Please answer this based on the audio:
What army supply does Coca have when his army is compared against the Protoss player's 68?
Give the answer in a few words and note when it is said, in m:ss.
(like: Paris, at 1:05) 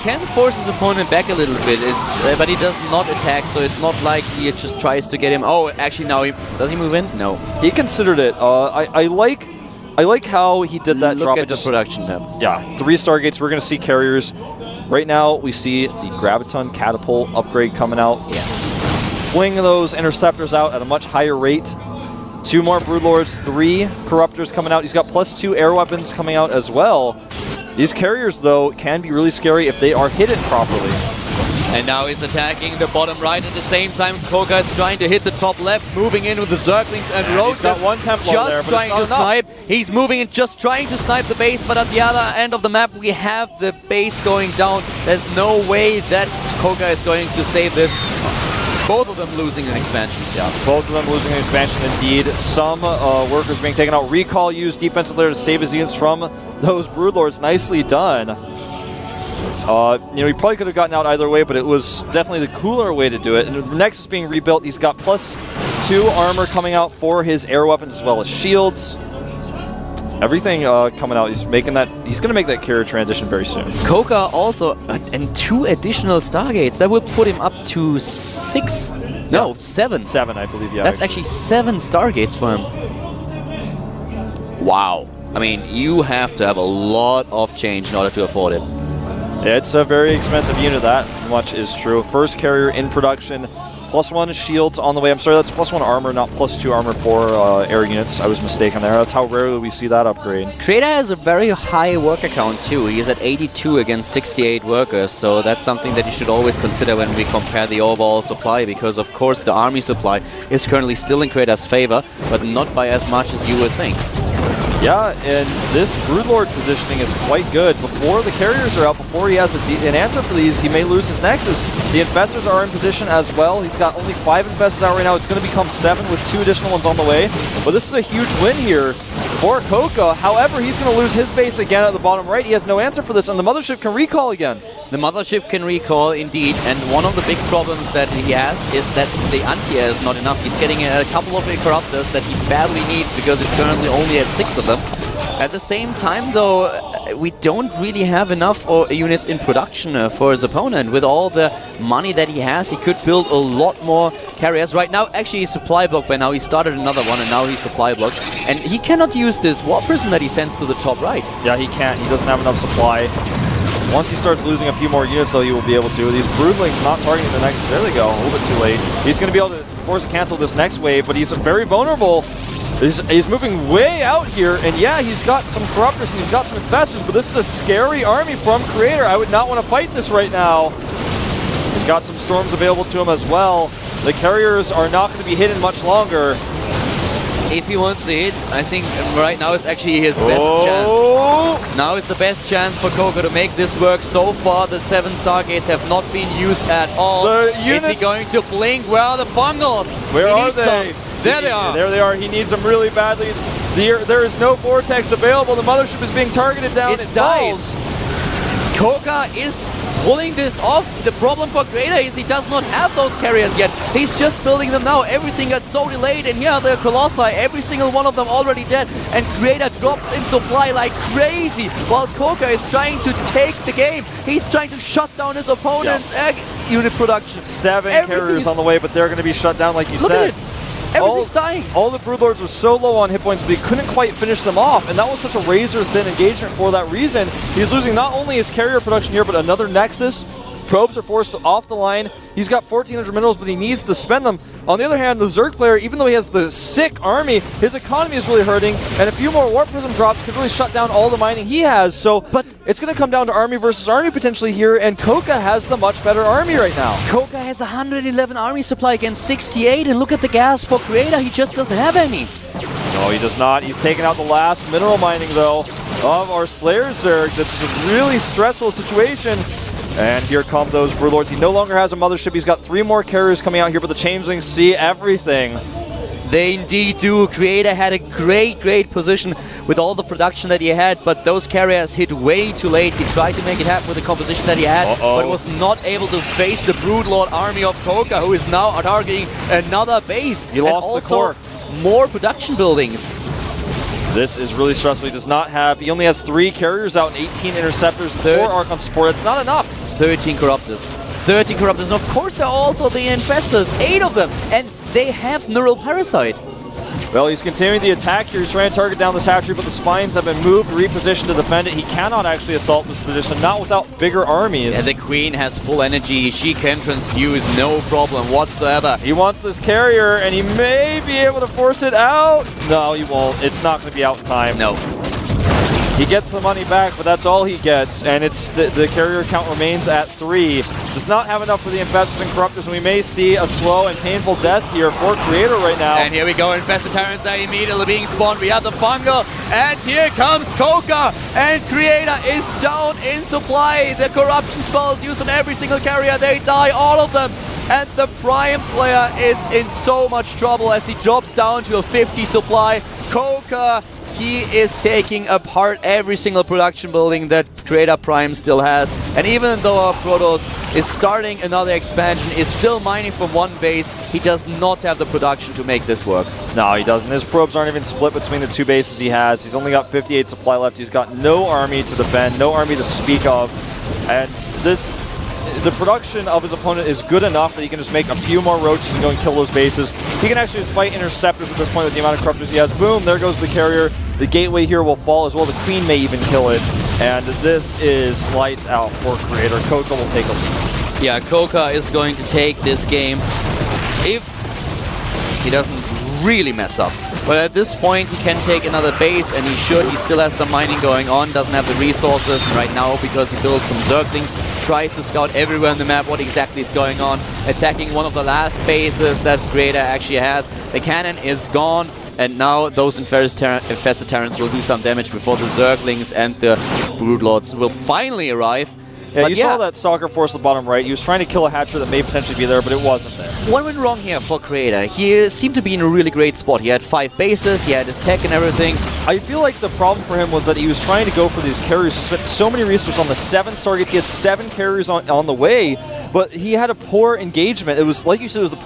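111, at 4:17.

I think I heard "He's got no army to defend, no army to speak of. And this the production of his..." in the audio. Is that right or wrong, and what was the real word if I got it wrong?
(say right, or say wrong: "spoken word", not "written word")
right.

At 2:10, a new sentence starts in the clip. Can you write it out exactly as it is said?
However, he's going to lose his base again at the bottom right.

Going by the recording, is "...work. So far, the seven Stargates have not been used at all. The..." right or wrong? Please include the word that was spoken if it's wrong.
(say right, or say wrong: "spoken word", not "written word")
right.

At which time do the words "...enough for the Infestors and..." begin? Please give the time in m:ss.
5:31.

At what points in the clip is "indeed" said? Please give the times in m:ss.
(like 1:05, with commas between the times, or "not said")
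0:51, 2:16, 4:36.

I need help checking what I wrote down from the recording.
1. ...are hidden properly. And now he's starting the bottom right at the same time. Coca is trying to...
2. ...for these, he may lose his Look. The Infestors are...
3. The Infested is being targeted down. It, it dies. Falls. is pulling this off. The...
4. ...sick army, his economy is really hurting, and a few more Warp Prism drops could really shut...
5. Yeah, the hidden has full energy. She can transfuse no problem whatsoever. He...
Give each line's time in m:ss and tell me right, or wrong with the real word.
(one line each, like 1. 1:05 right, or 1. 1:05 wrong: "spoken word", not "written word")
1. 0:29 wrong: "attacking", not "starting"
2. 2:00 wrong: "Nexus", not "Look"
3. 3:25 wrong: "Mothership", not "Infested"
4. 4:06 right
5. 5:14 wrong: "queen", not "hidden".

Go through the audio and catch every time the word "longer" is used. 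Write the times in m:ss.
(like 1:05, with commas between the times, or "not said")
3:05, 4:31.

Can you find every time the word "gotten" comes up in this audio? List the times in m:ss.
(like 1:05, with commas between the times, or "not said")
1:00.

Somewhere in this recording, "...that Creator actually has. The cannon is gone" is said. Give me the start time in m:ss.
6:49.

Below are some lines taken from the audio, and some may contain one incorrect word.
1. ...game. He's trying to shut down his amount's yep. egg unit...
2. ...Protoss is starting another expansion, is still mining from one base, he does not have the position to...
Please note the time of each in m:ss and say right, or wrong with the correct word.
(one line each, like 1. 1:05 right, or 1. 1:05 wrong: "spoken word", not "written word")
1. 3:43 wrong: "opponent", not "amount"
2. 5:59 wrong: "production", not "position".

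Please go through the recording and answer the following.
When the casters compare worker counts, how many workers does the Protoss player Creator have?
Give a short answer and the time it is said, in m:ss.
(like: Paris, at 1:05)
82, at 1:43.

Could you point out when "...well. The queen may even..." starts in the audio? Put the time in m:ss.
6:25.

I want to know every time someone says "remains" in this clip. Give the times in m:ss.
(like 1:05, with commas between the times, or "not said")
5:29.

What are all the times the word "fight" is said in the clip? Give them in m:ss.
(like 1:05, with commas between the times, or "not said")
2:59, 6:20.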